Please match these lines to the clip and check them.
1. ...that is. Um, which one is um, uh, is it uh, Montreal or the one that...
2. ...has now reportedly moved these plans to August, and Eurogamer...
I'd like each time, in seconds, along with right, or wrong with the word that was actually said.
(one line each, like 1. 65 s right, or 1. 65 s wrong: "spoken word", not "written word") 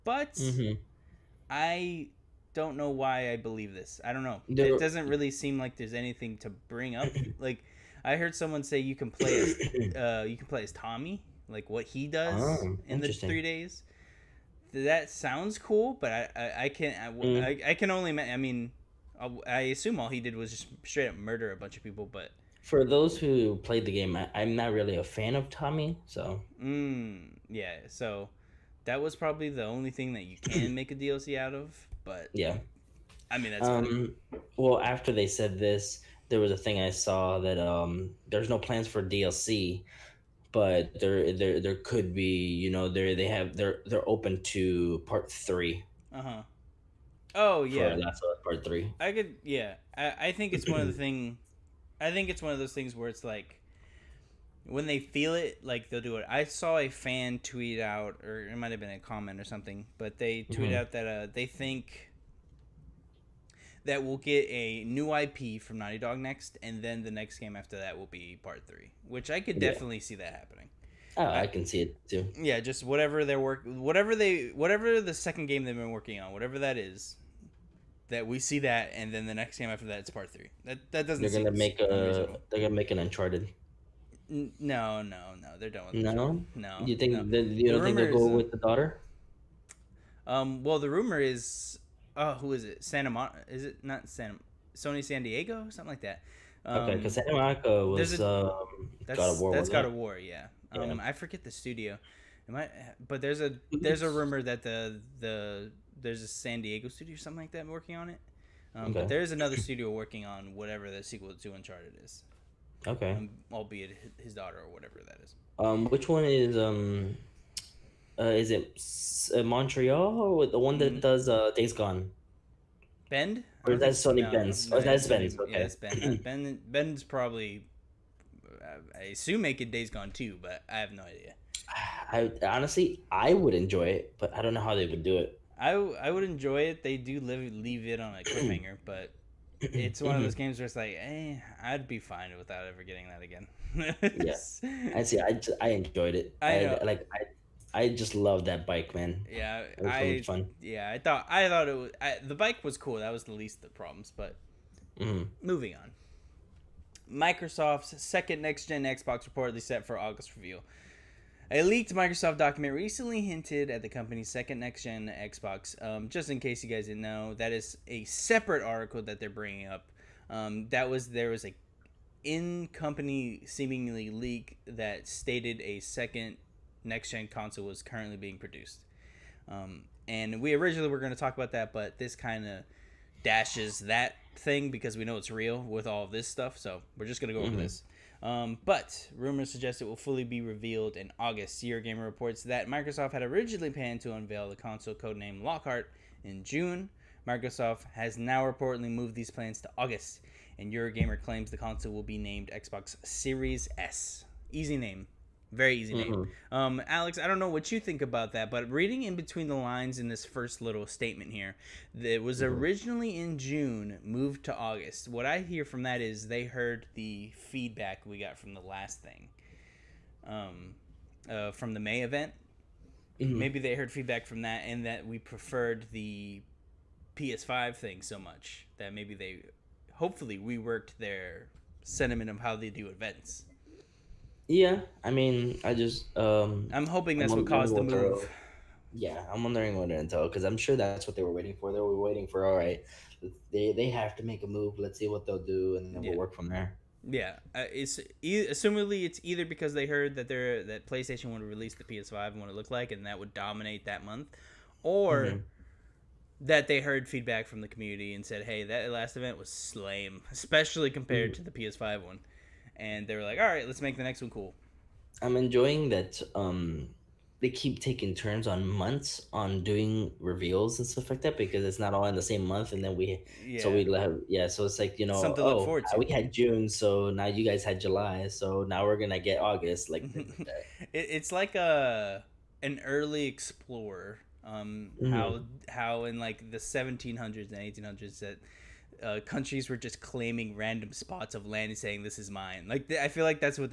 1. 115 s right
2. 197 s right.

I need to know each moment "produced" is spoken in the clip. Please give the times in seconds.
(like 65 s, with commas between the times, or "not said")
178 s.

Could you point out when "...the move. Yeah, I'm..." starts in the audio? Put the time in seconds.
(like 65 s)
237 s.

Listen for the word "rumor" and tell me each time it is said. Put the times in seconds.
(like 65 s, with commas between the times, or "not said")
90 s, 104 s, 189 s.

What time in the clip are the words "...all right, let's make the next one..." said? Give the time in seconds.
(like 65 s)
263 s.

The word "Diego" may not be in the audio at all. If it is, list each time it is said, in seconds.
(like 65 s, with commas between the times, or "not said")
95 s, 106 s.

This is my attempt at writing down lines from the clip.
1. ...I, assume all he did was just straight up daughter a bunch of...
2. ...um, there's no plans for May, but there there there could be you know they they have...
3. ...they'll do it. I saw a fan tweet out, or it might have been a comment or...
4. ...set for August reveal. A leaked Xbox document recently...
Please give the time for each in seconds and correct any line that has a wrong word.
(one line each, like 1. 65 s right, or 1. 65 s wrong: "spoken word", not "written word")
1. 19 s wrong: "murder", not "daughter"
2. 37 s wrong: "DLC", not "May"
3. 55 s right
4. 159 s wrong: "Microsoft", not "Xbox".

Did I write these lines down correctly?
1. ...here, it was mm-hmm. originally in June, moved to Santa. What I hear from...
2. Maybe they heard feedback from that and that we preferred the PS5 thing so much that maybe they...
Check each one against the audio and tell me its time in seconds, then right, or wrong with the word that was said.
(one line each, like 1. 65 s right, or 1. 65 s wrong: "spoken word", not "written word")
1. 211 s wrong: "August", not "Santa"
2. 223 s right.